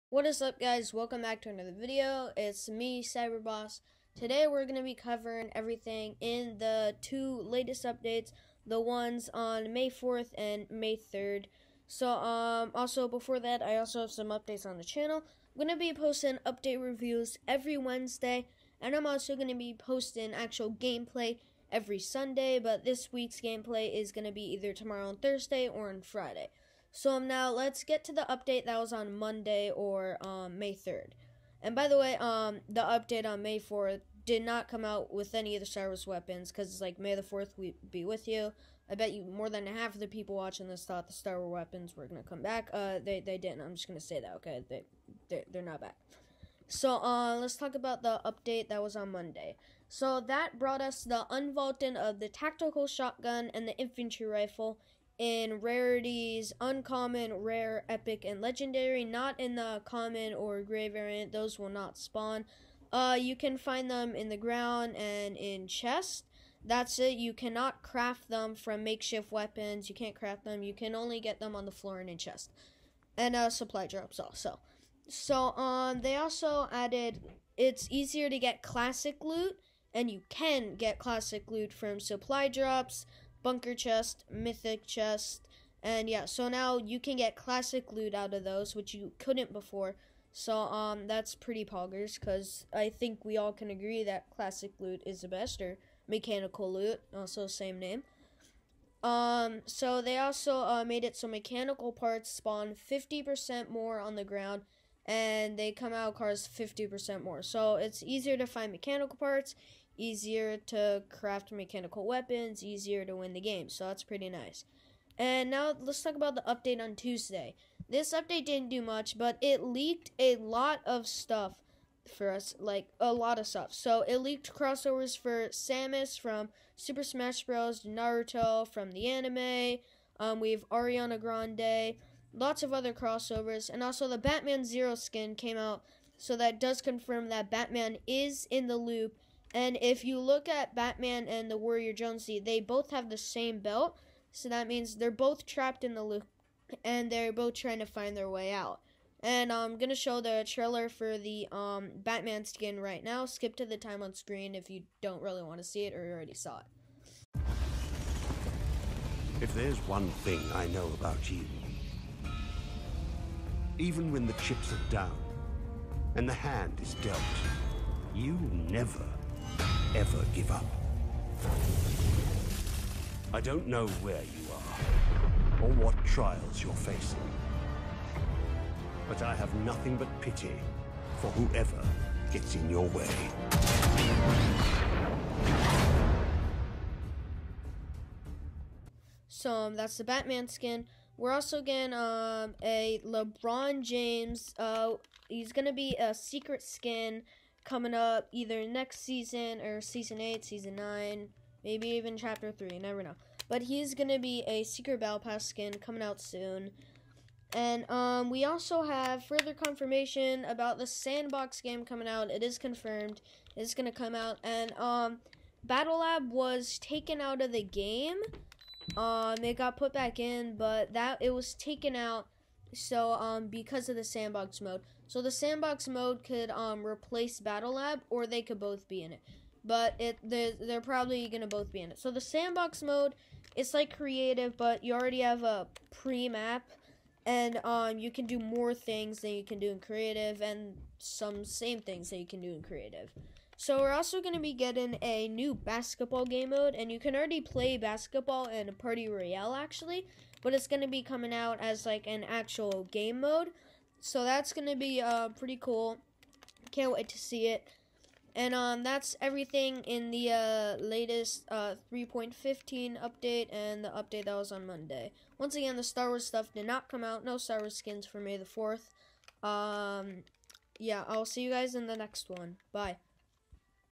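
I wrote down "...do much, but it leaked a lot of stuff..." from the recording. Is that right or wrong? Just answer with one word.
right.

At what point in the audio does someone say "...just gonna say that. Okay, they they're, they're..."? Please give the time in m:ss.
0:43.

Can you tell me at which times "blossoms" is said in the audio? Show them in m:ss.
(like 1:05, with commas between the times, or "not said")
not said.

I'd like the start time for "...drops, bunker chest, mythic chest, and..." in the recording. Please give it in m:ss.
1:22.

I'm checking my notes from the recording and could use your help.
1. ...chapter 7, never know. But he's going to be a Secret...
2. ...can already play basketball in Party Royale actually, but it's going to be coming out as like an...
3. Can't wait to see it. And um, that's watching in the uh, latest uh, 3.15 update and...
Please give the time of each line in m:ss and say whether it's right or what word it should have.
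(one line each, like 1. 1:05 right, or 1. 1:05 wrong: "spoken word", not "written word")
1. 3:22 wrong: "3", not "7"
2. 4:06 right
3. 4:16 wrong: "everything", not "watching".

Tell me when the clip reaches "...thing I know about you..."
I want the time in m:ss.
2:40.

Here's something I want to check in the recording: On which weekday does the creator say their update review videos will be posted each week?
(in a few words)
Wednesday.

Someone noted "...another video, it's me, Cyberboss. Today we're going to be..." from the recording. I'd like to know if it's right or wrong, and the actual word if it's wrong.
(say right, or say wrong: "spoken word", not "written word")
right.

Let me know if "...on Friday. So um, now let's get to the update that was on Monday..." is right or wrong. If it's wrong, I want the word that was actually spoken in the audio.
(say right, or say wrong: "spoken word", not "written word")
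right.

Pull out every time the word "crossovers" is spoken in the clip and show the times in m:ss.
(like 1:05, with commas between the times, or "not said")
2:04, 2:12.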